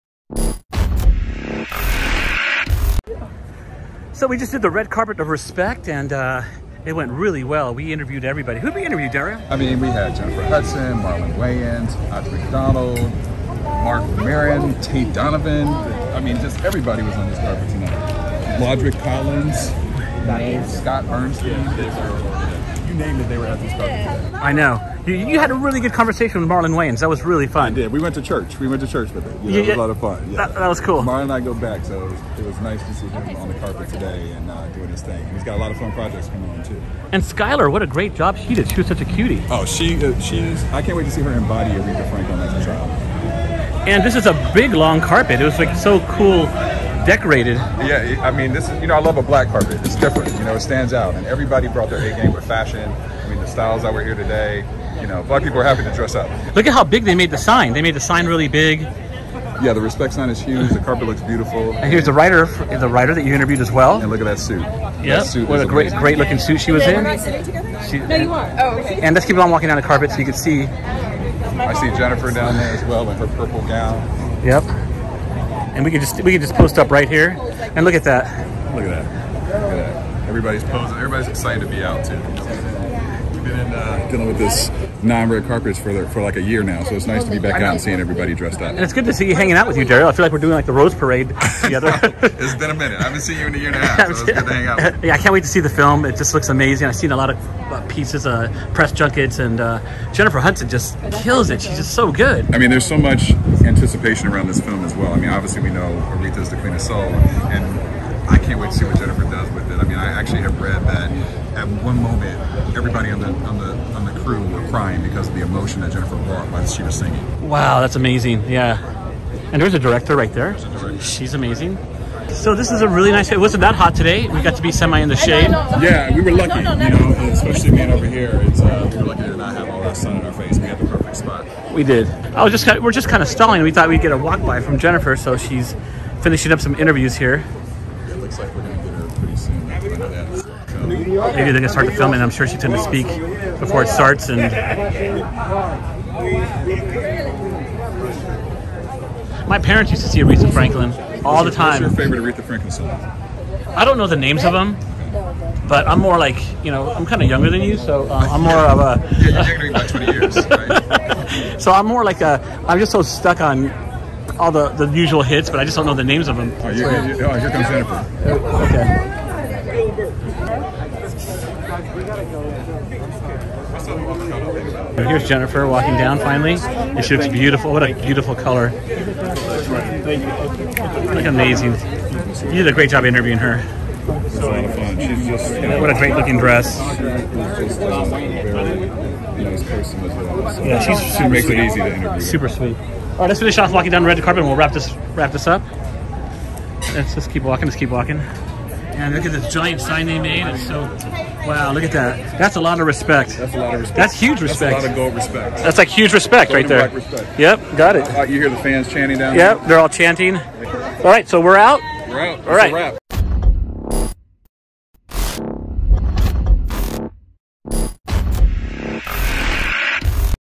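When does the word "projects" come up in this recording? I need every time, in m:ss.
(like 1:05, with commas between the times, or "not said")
0:35.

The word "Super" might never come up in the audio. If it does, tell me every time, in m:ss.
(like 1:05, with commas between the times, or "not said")
3:12.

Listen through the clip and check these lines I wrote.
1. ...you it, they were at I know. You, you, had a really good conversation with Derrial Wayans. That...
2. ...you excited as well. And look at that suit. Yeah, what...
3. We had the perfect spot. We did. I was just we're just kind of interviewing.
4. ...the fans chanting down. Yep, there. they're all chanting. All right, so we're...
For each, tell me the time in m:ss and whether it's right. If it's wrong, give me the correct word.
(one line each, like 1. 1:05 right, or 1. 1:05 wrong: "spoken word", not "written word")
1. 0:22 wrong: "Marlon", not "Derrial"
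2. 1:03 wrong: "interviewed", not "excited"
3. 2:10 wrong: "stalling", not "interviewing"
4. 3:28 right.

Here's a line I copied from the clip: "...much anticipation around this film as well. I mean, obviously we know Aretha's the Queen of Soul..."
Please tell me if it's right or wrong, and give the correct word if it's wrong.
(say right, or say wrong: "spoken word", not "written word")
right.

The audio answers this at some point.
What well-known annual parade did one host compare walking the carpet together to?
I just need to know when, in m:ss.
1:30.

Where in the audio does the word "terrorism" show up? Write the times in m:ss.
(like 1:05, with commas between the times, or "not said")
not said.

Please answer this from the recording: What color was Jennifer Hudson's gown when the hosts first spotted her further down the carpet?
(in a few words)
purple.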